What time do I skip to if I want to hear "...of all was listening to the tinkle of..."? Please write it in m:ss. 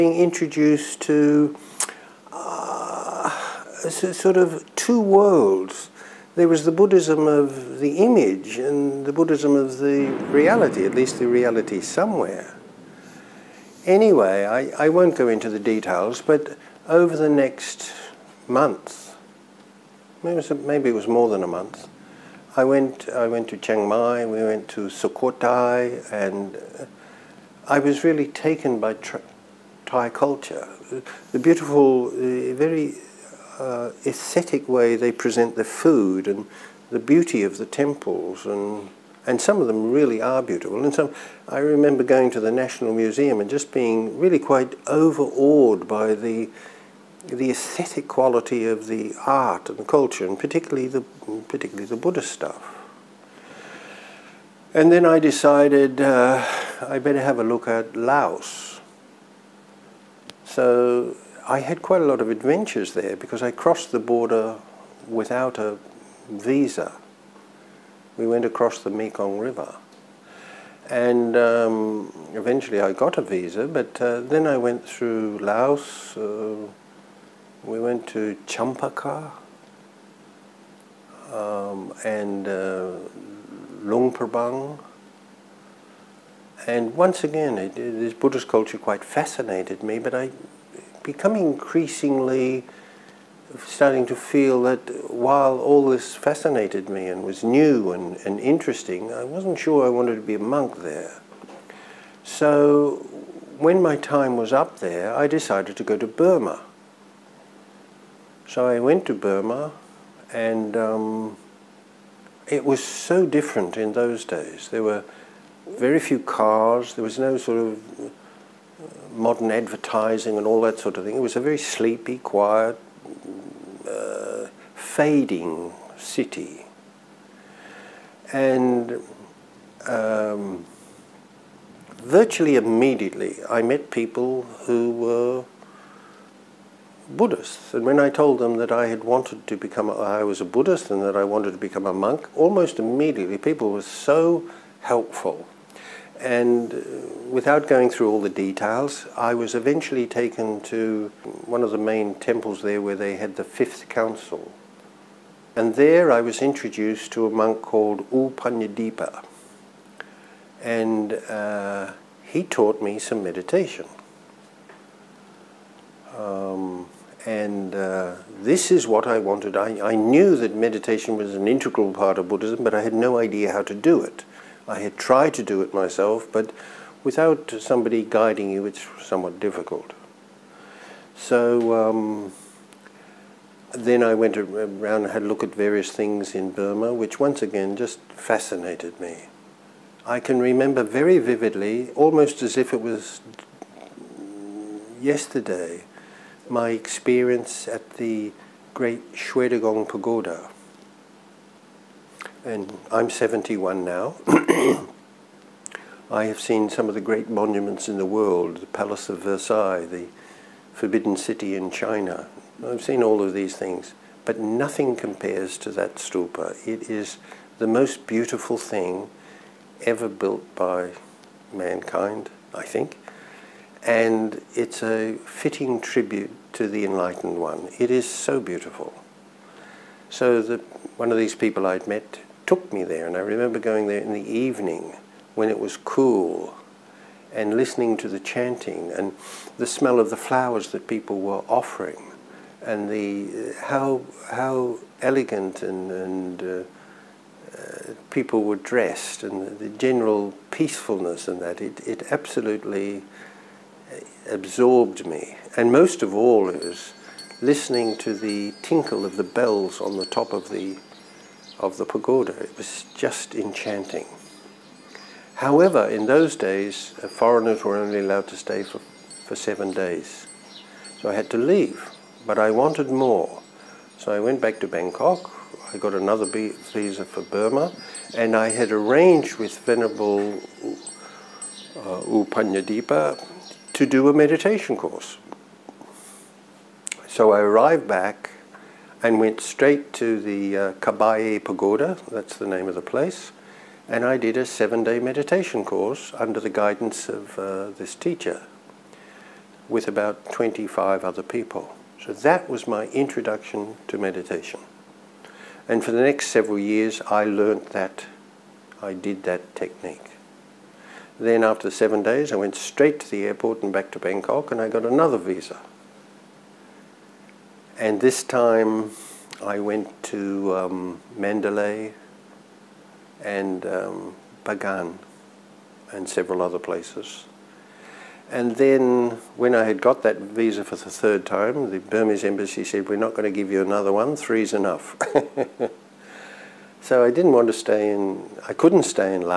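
4:16.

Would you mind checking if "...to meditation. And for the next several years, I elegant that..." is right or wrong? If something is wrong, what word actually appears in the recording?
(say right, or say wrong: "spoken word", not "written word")
wrong: "learnt", not "elegant".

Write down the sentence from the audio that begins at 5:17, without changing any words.
And this time, I went to um, Mandalay and um, Bagan and several other places.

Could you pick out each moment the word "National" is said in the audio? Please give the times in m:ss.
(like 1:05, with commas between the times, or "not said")
0:42.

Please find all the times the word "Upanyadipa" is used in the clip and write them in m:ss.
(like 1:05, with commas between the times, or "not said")
2:38, 4:42.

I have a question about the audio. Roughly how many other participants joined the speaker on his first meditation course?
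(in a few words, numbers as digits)
25.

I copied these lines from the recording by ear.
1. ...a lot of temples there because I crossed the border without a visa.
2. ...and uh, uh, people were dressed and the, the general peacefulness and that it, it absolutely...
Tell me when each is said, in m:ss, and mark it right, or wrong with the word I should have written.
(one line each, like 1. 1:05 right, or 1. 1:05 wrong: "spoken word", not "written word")
1. 1:02 wrong: "adventures", not "temples"
2. 4:05 right.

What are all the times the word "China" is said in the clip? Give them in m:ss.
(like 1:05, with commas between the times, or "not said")
3:31.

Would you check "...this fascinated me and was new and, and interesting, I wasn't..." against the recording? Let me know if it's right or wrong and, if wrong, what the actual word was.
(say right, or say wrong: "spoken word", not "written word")
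right.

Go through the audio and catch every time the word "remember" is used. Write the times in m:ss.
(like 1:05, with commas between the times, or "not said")
0:41, 3:10, 3:53.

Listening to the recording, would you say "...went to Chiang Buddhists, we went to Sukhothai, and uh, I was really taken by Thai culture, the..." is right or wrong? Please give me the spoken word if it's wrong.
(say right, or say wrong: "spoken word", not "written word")
wrong: "Mai", not "Buddhists".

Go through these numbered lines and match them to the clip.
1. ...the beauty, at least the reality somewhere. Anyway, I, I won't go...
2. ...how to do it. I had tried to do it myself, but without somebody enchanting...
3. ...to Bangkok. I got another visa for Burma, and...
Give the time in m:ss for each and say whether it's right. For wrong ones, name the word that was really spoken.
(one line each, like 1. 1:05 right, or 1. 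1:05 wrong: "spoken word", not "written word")
1. 0:09 wrong: "reality", not "beauty"
2. 2:53 wrong: "guiding", not "enchanting"
3. 4:34 right.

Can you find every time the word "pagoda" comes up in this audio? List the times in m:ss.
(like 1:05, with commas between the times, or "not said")
3:19, 4:21, 4:51.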